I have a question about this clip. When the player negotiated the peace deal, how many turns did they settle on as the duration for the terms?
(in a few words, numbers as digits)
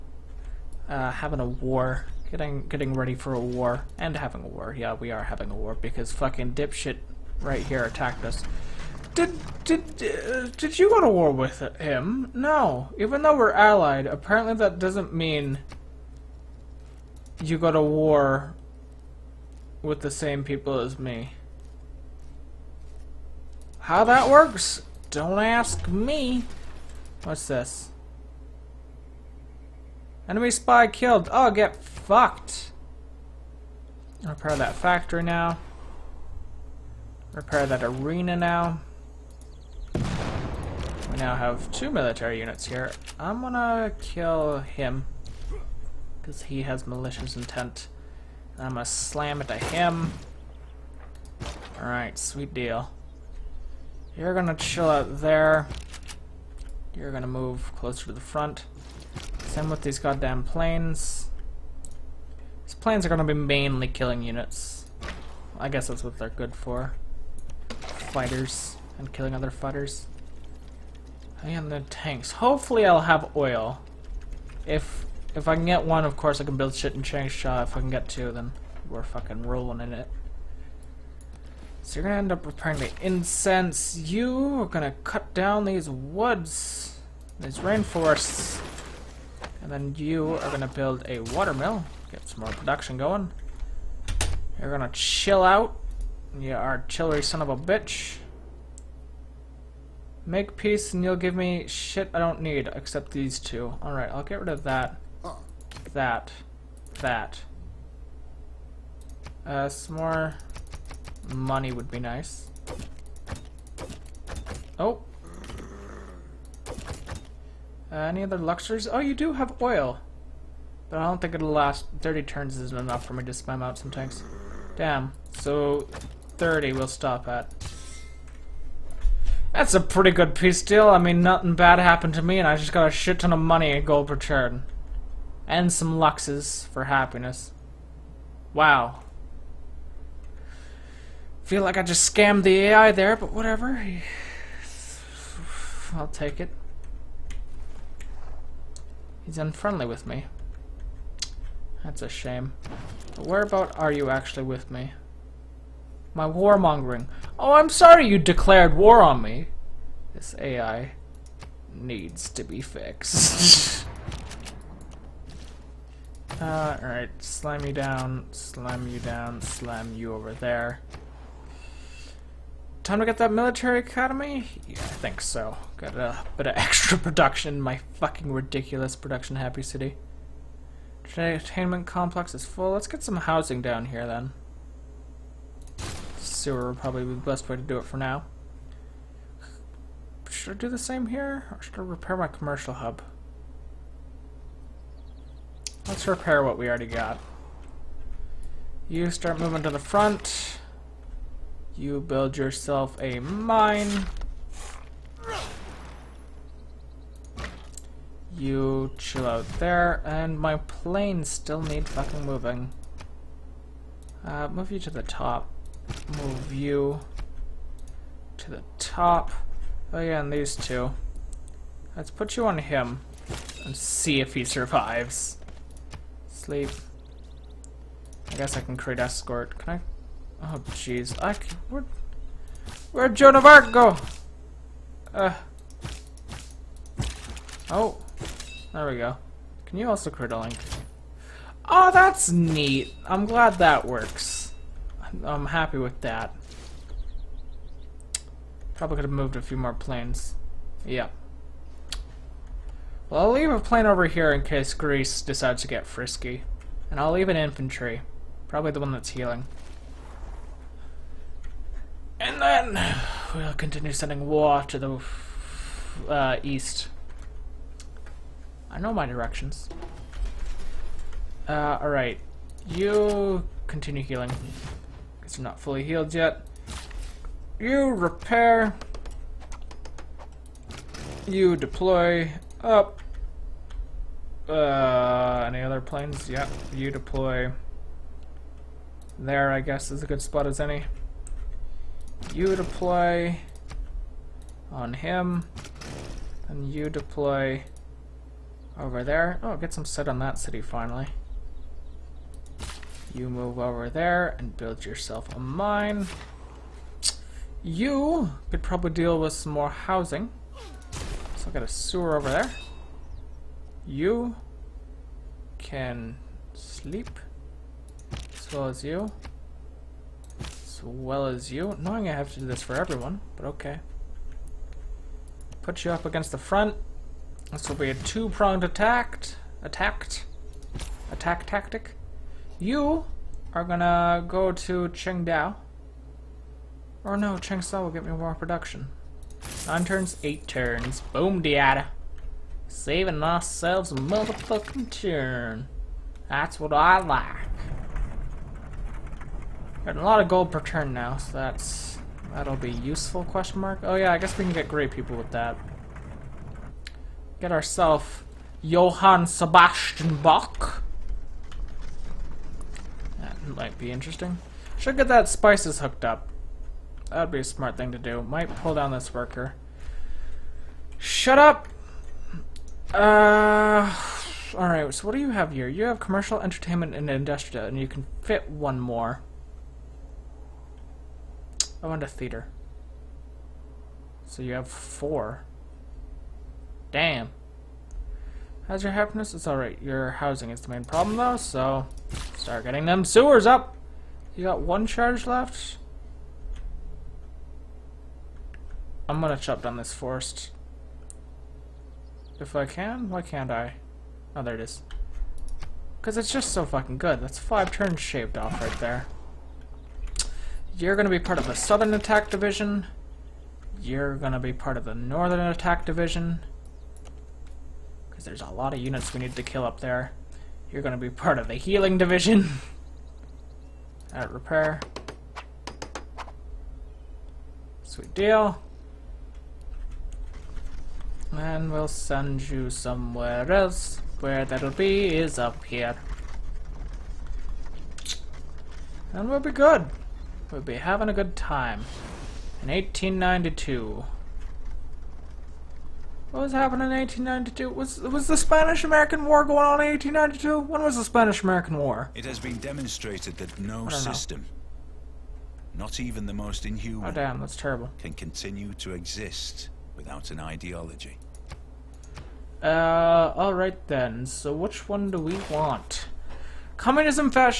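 30.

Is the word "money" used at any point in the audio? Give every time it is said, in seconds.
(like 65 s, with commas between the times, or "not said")
111 s, 133 s.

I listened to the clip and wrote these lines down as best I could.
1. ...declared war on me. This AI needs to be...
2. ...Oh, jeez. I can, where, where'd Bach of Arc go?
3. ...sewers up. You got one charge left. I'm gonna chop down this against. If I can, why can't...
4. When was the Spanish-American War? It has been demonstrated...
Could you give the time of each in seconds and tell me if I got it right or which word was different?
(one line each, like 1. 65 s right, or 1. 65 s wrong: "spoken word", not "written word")
1. 158 s right
2. 230 s wrong: "Joan", not "Bach"
3. 393 s wrong: "forest", not "against"
4. 450 s right.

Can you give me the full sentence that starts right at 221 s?
Let's put you on him and see if he survives.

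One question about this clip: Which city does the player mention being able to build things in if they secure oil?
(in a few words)
Changsha.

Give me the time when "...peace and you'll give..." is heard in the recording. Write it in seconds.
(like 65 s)
100 s.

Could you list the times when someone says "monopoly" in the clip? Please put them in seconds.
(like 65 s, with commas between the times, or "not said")
not said.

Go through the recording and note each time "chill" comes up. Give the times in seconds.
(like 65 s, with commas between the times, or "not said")
54 s, 94 s, 208 s.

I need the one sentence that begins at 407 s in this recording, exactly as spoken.
That's five turns shaved off right there.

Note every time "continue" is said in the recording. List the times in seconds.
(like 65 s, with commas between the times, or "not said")
263 s, 273 s, 458 s.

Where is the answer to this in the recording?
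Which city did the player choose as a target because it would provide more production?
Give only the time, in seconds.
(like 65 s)
337 s.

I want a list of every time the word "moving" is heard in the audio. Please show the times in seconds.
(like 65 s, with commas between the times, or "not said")
199 s, 212 s.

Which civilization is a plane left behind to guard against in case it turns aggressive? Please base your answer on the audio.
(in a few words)
Greece.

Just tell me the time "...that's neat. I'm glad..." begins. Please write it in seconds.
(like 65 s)
241 s.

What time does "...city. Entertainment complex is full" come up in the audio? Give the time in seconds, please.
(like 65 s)
179 s.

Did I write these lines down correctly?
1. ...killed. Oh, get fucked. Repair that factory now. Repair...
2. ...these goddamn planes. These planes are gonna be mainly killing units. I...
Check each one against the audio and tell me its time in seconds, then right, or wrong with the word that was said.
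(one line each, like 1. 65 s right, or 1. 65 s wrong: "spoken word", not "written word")
1. 30 s right
2. 59 s right.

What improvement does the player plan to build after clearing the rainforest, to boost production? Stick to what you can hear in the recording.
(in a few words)
Watermill.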